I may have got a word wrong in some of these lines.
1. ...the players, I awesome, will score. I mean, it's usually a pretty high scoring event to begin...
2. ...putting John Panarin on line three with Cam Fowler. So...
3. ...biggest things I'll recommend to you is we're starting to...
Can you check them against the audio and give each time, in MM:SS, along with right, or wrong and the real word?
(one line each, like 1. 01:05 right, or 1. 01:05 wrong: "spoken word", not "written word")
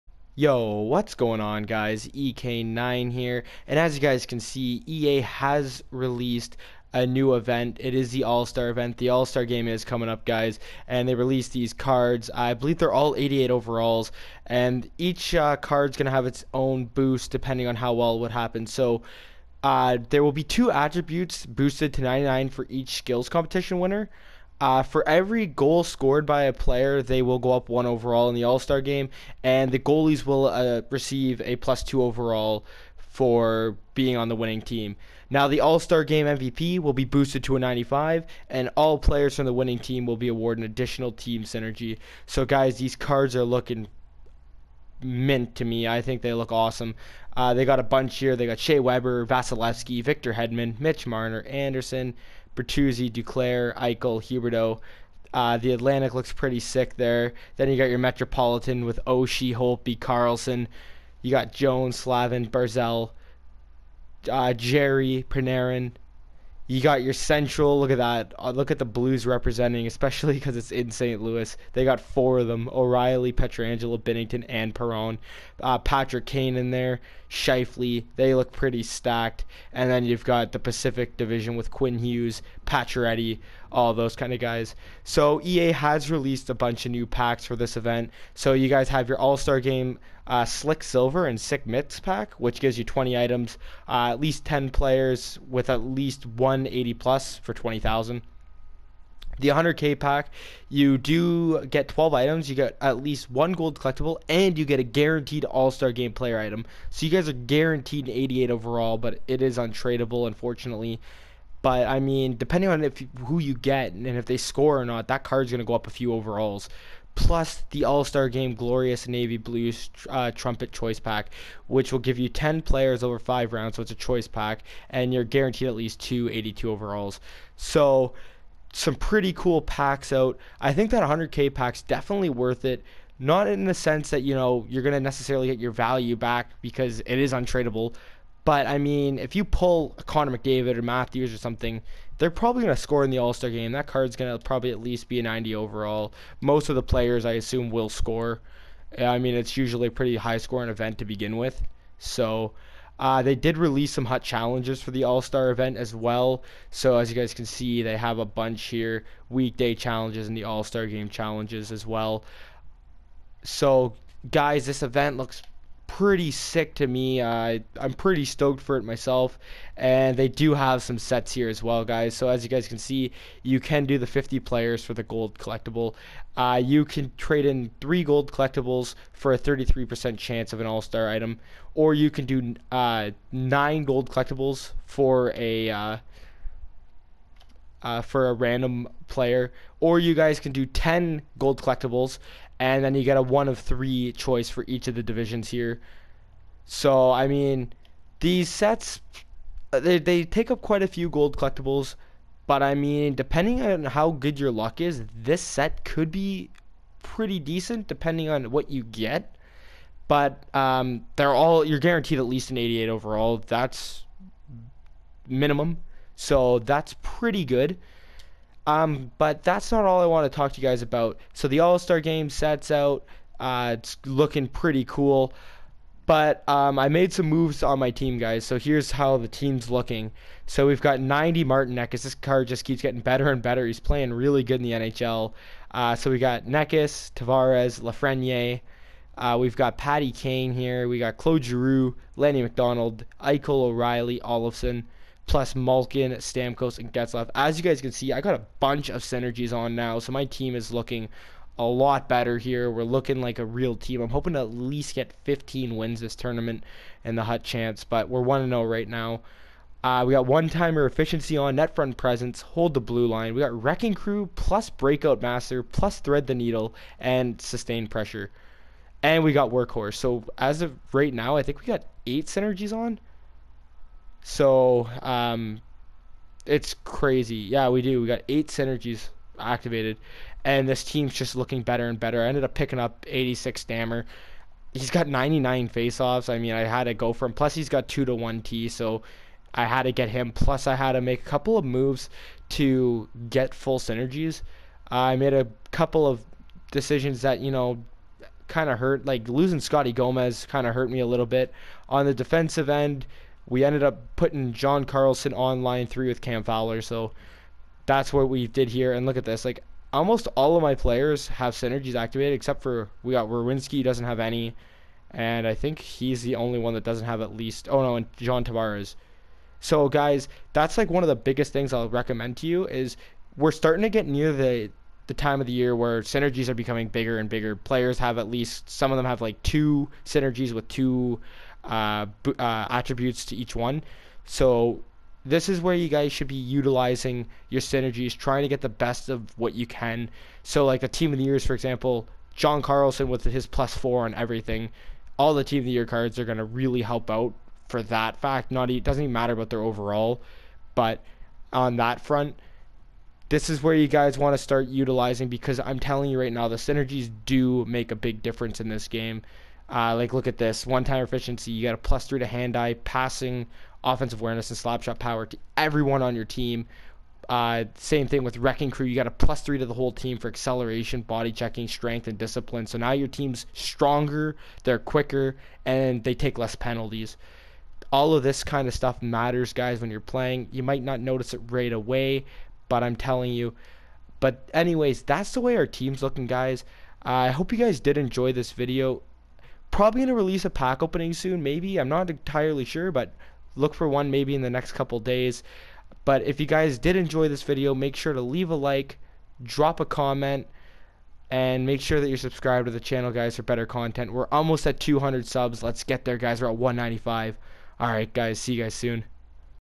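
1. 02:26 wrong: "assume", not "awesome"
2. 05:04 wrong: "Carlson", not "Panarin"
3. 05:21 right.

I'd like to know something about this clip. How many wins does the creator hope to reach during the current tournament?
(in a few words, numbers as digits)
15.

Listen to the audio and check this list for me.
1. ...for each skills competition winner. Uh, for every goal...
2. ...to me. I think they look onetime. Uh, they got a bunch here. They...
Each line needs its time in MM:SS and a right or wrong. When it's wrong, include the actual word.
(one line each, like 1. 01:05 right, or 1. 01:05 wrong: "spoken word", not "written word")
1. 00:22 right
2. 00:45 wrong: "awesome", not "onetime".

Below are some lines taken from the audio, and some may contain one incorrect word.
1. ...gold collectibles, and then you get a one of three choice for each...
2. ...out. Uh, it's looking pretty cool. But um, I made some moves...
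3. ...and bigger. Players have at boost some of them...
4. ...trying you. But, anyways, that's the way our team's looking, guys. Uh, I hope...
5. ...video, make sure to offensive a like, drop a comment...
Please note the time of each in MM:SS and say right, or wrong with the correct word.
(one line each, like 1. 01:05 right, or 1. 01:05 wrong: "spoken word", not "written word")
1. 03:11 right
2. 03:42 right
3. 05:27 wrong: "least", not "boost"
4. 06:22 wrong: "telling", not "trying"
5. 06:37 wrong: "leave", not "offensive".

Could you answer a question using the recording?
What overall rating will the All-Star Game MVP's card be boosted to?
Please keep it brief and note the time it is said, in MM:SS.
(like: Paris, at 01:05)
95, at 00:37.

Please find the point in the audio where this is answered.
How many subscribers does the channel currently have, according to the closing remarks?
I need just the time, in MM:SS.
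06:46.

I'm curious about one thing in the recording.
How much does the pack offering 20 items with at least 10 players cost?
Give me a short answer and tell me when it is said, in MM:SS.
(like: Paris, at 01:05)
20,000, at 01:37.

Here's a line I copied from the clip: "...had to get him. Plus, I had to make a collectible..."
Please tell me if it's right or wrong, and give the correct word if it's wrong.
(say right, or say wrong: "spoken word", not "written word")
wrong: "couple", not "collectible".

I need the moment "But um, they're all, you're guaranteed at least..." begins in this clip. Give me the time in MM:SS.
03:30.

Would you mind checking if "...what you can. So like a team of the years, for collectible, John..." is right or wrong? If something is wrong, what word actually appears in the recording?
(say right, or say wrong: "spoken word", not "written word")
wrong: "example", not "collectible".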